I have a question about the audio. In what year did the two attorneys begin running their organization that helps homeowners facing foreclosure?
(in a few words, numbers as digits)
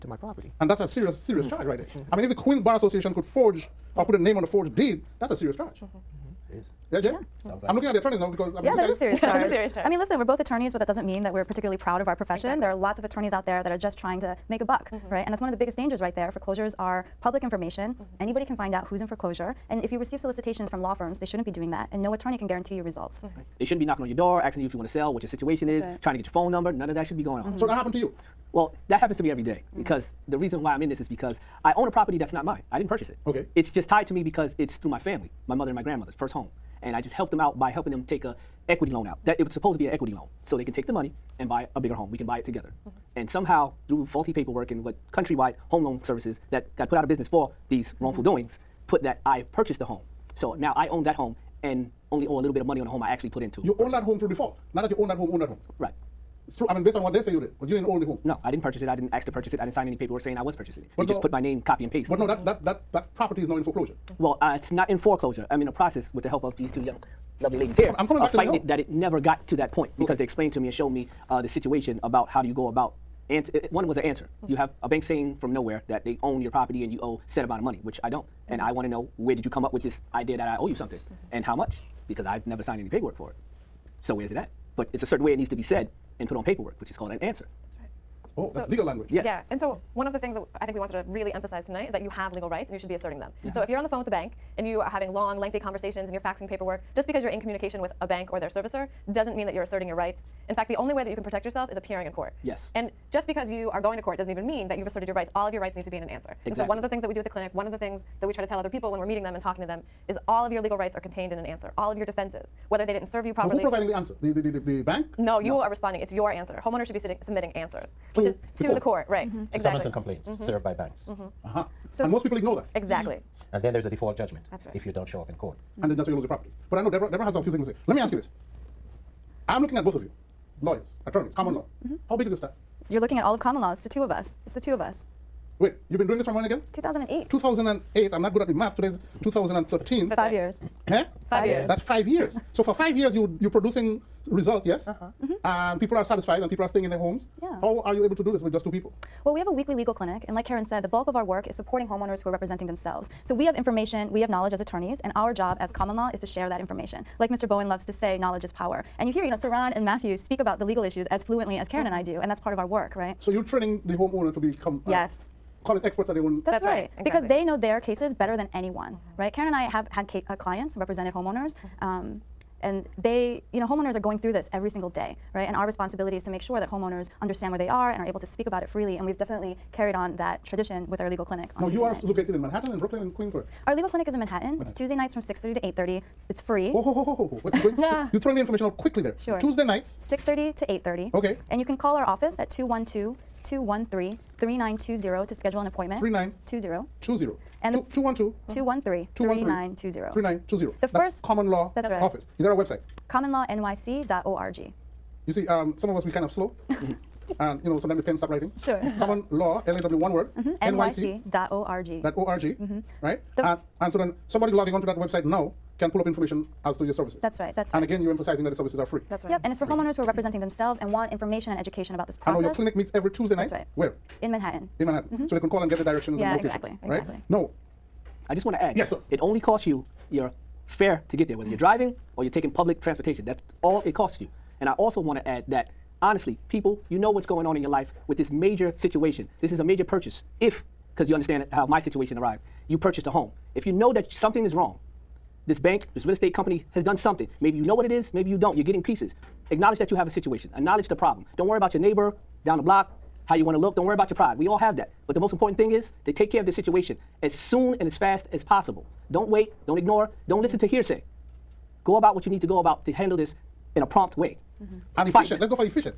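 2008.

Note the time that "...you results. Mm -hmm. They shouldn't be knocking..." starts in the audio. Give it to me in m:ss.
0:22.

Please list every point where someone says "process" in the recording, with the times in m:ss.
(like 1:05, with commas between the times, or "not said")
1:05, 3:42.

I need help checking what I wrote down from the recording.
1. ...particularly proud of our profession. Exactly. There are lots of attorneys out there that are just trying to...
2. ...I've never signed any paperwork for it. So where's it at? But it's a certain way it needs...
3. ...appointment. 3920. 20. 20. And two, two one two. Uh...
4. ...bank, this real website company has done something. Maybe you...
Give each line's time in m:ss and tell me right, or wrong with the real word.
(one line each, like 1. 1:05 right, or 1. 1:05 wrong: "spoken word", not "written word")
1. 0:11 right
2. 1:22 right
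3. 3:15 right
4. 4:05 wrong: "estate", not "website".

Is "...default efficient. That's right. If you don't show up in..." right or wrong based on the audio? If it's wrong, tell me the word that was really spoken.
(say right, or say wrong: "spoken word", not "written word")
wrong: "judgment", not "efficient".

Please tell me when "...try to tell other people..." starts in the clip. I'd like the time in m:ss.
1:48.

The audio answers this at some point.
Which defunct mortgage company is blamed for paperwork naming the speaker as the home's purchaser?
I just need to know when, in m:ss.
0:45.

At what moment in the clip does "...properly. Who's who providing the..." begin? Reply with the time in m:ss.
1:53.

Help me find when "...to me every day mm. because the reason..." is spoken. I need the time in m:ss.
0:29.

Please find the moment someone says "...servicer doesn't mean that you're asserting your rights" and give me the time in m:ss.
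1:38.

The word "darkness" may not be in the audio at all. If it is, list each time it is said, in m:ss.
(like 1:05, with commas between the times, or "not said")
not said.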